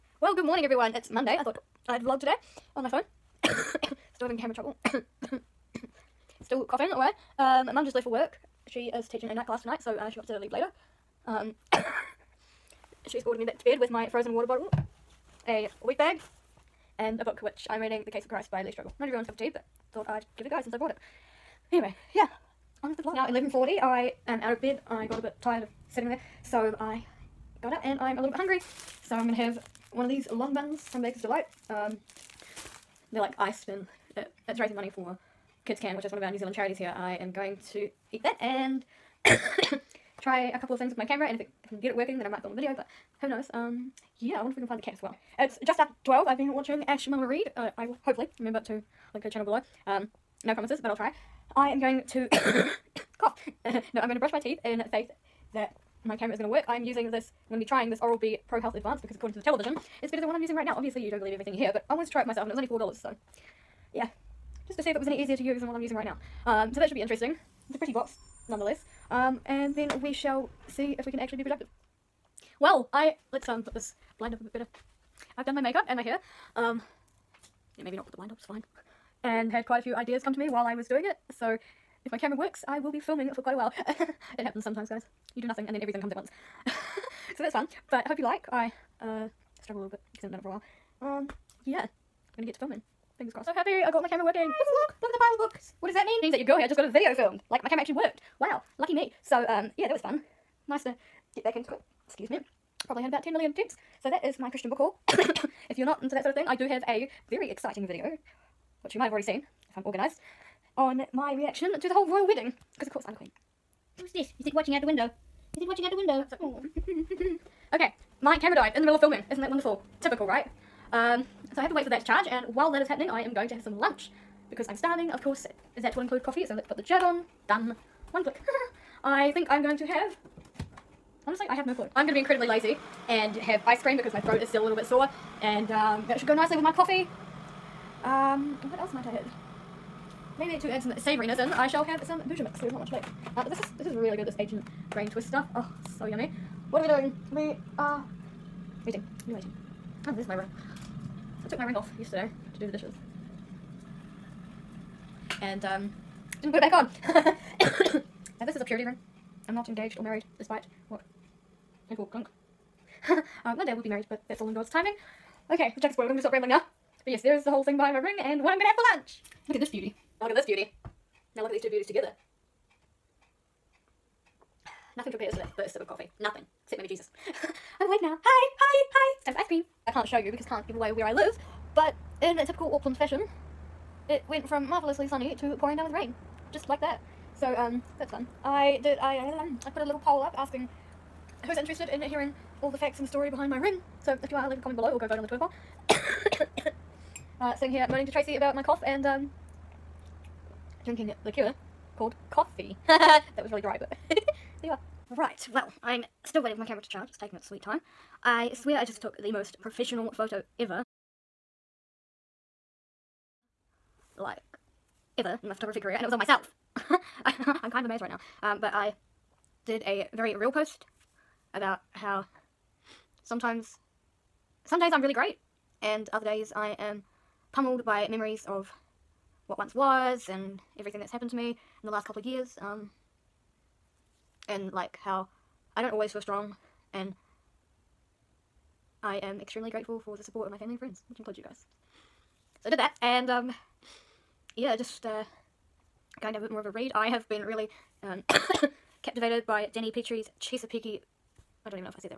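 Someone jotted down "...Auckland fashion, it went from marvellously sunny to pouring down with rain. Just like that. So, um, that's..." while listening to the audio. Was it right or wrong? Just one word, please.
right.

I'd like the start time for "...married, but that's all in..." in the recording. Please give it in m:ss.
2:43.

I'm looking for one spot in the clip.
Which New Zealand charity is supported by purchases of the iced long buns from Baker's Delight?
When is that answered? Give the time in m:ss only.
0:35.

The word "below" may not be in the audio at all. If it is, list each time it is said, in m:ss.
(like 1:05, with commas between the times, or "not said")
0:49, 3:14.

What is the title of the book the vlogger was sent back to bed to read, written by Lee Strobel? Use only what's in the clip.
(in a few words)
The Case of Christ.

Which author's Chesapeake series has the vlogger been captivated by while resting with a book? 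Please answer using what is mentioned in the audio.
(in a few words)
Dani Pettrey.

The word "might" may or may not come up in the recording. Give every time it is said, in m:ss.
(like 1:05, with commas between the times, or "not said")
0:42, 1:48, 2:18.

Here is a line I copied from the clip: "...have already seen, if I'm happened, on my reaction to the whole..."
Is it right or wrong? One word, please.
wrong.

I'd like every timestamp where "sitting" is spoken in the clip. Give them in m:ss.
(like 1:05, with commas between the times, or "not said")
0:25, 3:17.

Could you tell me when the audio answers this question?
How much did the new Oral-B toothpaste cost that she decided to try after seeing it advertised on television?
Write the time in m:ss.
1:02.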